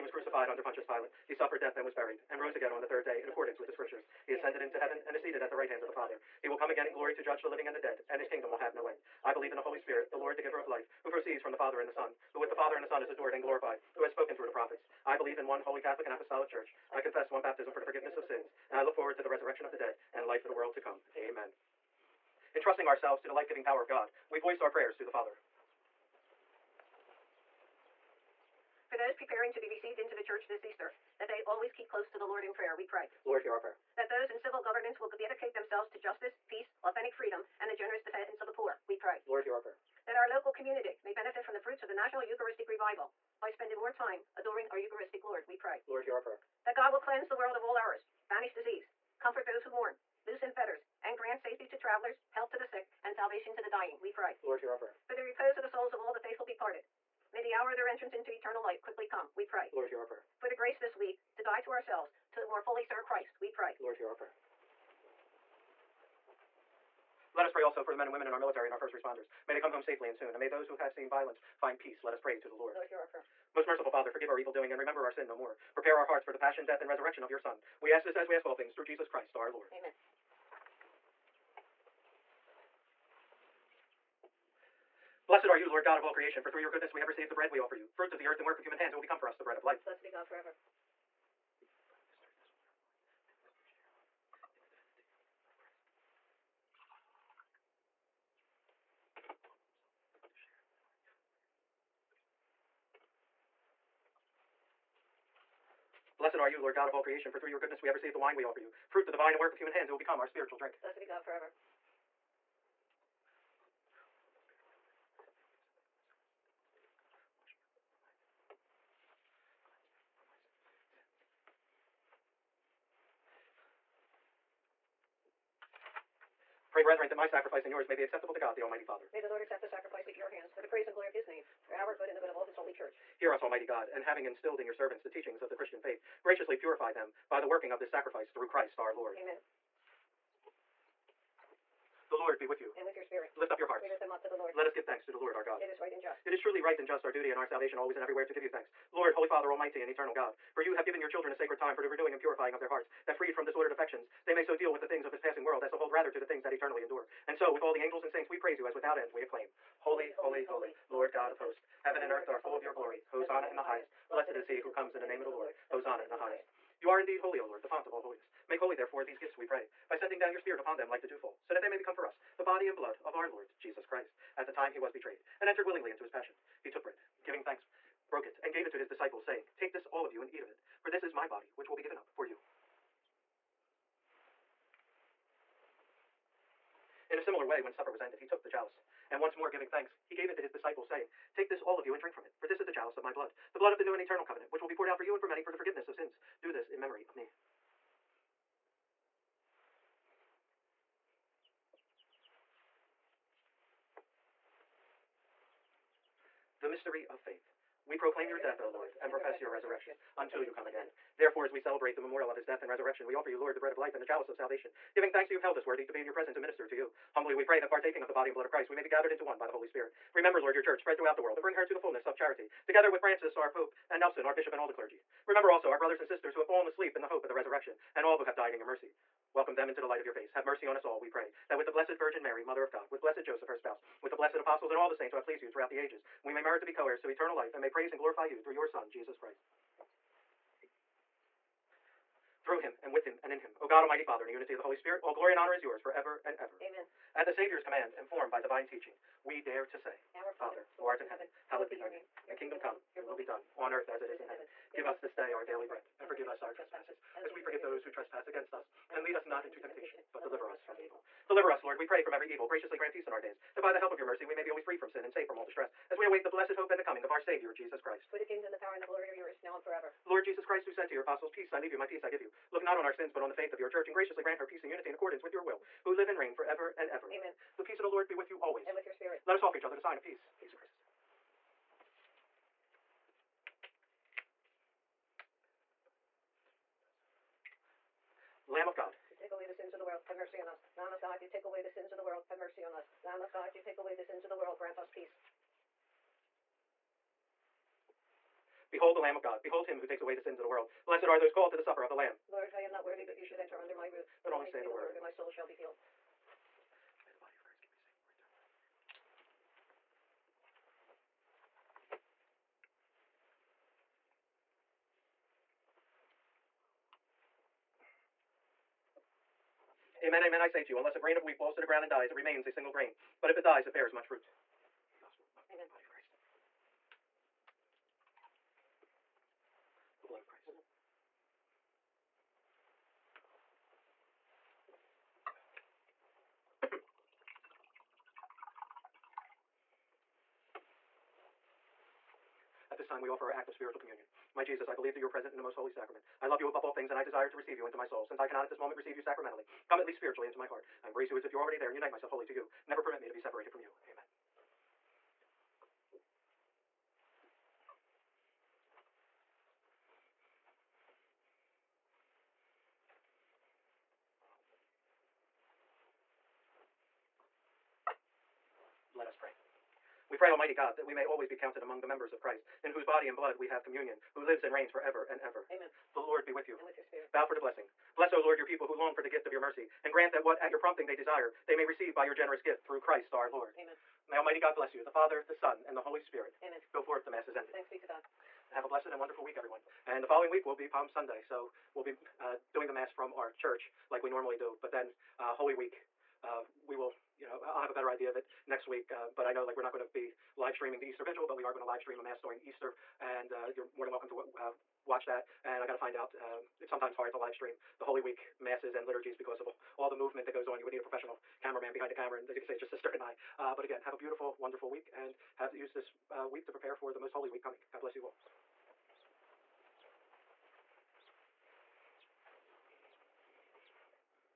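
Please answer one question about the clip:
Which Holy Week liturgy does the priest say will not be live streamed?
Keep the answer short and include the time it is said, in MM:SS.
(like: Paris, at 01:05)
The Easter Vigil, at 06:40.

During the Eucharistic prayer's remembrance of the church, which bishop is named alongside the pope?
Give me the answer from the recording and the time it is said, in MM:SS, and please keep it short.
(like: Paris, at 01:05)
Nelson, at 03:43.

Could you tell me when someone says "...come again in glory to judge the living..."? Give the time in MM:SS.
00:06.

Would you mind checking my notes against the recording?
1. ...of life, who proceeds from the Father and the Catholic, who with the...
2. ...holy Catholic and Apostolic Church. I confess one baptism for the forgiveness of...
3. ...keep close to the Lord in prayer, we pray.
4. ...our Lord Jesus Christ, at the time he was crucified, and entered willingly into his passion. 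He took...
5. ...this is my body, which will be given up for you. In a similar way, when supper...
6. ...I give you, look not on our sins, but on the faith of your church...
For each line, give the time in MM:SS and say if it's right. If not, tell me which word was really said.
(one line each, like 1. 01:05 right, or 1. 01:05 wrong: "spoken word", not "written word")
1. 00:10 wrong: "Son", not "Catholic"
2. 00:15 right
3. 00:31 right
4. 02:53 wrong: "betrayed", not "crucified"
5. 03:00 right
6. 04:32 right.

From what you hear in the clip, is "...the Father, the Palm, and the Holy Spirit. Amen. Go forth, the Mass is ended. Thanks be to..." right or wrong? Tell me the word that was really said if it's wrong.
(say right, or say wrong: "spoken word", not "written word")
wrong: "Son", not "Palm".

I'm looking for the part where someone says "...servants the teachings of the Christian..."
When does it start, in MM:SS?
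02:14.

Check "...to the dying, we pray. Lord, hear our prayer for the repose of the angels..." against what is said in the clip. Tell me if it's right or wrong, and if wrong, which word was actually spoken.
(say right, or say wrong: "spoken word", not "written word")
wrong: "souls", not "angels".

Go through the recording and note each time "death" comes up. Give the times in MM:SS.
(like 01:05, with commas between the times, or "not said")
00:01, 01:16, 03:28, 03:32.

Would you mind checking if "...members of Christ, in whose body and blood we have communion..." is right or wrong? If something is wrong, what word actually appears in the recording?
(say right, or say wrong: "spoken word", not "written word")
right.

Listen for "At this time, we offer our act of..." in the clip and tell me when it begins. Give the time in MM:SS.
05:42.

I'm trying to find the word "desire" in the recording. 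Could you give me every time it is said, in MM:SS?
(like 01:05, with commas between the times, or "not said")
05:47, 06:20.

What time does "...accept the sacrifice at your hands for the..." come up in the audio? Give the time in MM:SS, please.
02:09.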